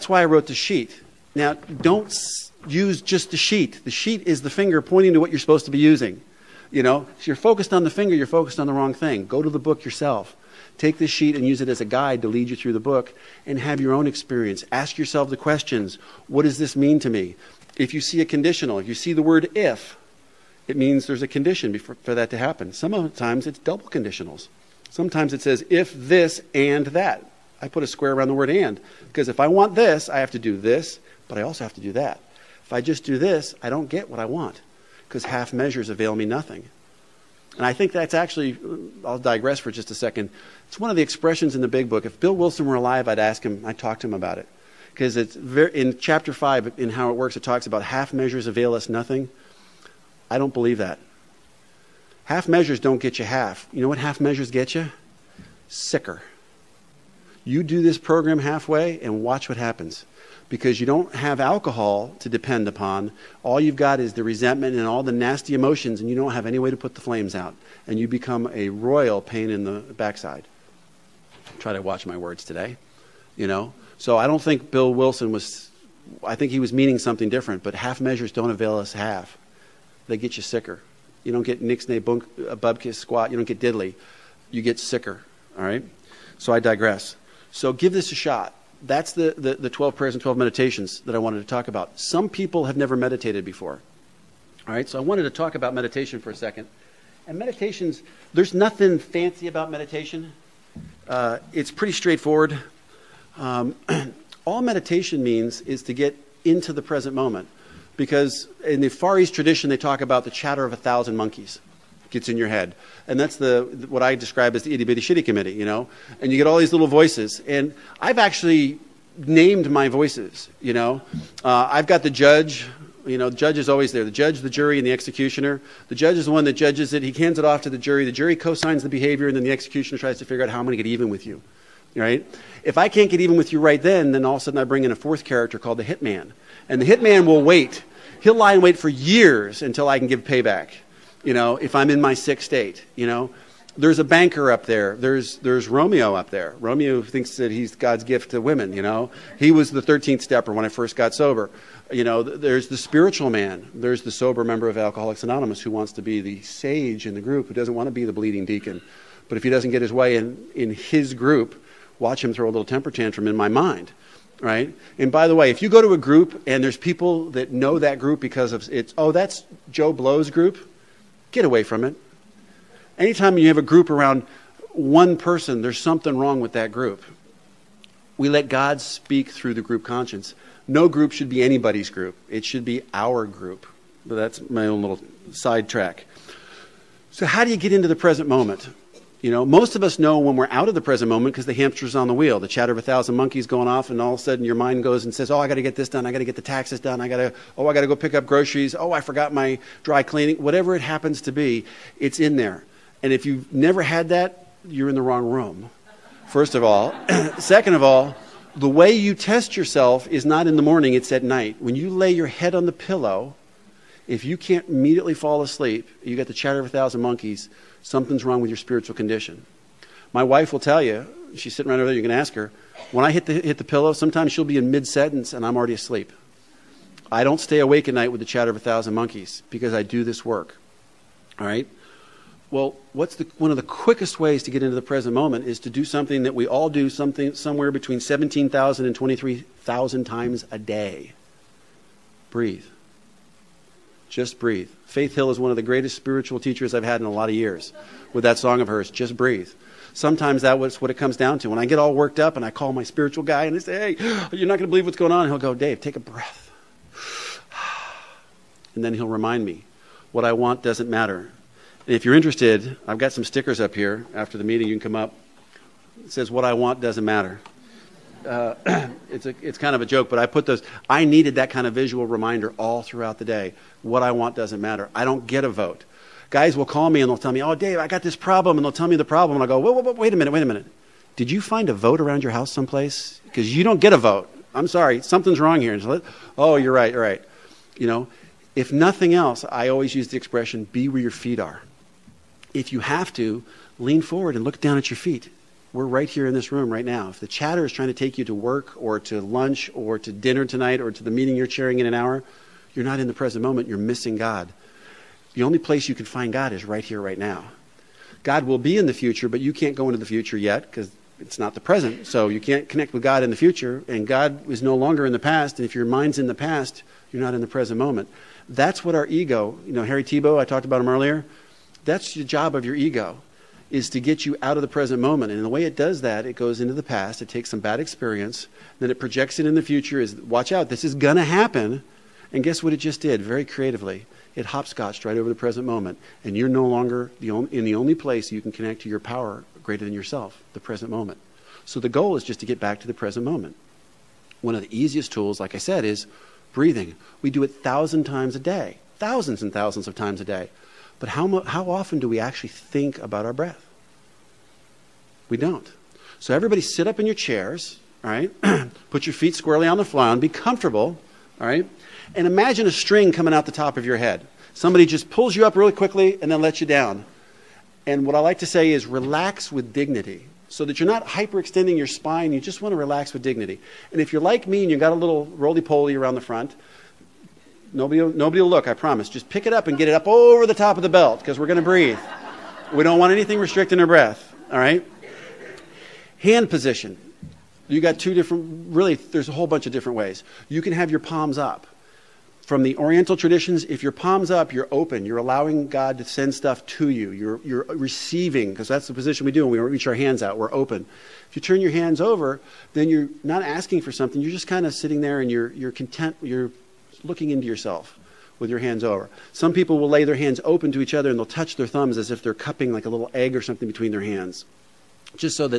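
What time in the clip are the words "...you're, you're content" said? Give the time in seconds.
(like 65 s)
405 s.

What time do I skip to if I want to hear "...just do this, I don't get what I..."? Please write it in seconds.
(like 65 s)
32 s.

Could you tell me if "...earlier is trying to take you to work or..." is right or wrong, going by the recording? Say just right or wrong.
wrong.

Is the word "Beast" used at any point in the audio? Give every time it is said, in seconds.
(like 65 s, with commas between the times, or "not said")
not said.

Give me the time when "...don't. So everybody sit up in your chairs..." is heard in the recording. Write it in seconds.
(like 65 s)
355 s.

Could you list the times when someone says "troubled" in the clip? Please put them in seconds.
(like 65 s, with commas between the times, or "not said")
not said.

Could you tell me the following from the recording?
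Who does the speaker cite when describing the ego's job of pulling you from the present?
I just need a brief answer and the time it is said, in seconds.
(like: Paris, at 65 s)
Harry Tiebout, at 319 s.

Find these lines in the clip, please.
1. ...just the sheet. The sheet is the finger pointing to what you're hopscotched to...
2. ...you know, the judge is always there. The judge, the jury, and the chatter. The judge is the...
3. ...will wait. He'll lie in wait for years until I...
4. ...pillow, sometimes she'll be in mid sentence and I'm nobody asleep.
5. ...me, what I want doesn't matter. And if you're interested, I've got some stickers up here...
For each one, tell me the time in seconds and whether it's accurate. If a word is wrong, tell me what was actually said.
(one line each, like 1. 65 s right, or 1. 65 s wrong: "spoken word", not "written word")
1. 3 s wrong: "supposed", not "hopscotched"
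2. 123 s wrong: "executioner", not "chatter"
3. 137 s right
4. 223 s wrong: "already", not "nobody"
5. 259 s right.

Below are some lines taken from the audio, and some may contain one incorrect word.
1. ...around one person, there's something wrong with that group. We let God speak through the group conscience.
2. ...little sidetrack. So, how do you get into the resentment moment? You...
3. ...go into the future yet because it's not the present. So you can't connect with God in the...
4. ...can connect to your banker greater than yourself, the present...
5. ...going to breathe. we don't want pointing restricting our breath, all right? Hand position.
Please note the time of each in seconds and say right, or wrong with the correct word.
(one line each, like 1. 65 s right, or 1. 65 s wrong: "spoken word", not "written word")
1. 173 s right
2. 184 s wrong: "present", not "resentment"
3. 309 s right
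4. 338 s wrong: "power", not "banker"
5. 381 s wrong: "anything", not "pointing".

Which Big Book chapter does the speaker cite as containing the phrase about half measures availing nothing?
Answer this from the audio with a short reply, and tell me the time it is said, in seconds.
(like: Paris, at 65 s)
Chapter 5, at 45 s.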